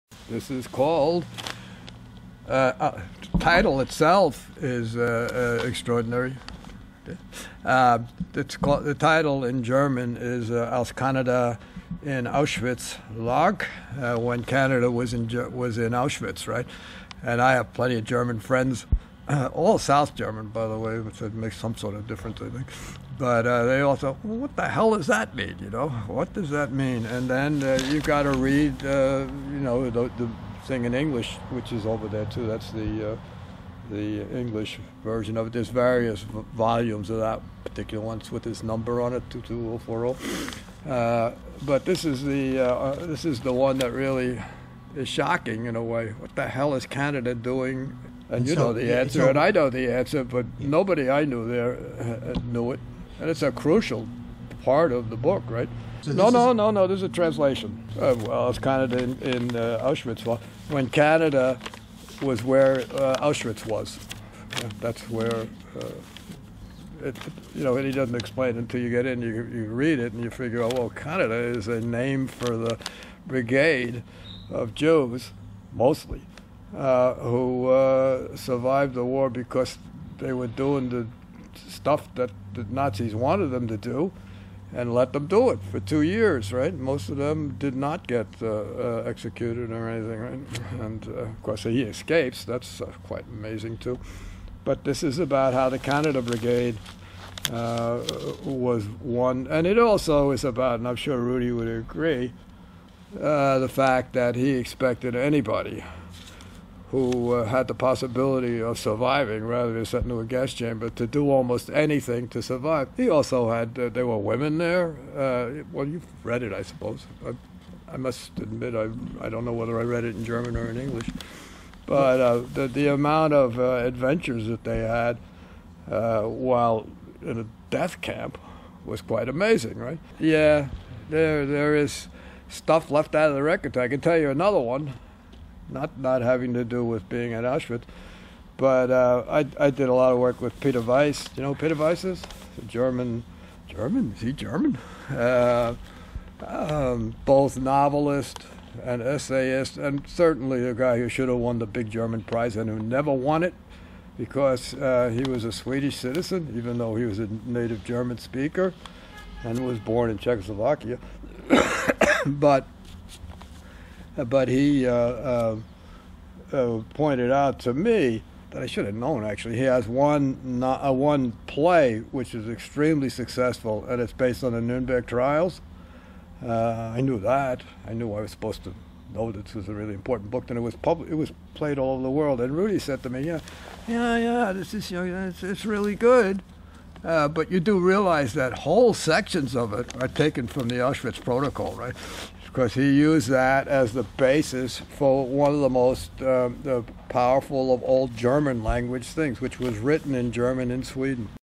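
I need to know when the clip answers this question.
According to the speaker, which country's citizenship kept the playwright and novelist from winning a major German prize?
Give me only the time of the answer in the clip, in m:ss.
2:35.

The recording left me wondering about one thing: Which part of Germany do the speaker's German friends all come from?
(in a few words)
South German.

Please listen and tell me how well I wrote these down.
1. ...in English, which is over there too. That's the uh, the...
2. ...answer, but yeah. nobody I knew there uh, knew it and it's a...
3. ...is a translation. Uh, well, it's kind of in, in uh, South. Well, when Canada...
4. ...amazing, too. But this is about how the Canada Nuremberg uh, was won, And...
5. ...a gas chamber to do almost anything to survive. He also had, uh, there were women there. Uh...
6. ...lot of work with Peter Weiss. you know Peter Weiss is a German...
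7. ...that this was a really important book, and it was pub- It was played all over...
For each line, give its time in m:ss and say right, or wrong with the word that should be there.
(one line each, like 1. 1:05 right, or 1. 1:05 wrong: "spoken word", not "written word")
1. 0:30 right
2. 0:49 right
3. 0:56 wrong: "Auschwitz", not "South"
4. 1:33 wrong: "Brigade", not "Nuremberg"
5. 1:50 right
6. 2:19 right
7. 2:59 right.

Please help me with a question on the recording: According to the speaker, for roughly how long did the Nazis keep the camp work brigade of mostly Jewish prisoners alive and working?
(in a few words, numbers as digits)
2 years.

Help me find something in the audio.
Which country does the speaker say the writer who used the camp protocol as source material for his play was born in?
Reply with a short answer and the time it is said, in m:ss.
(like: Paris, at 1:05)
Czechoslovakia, at 2:40.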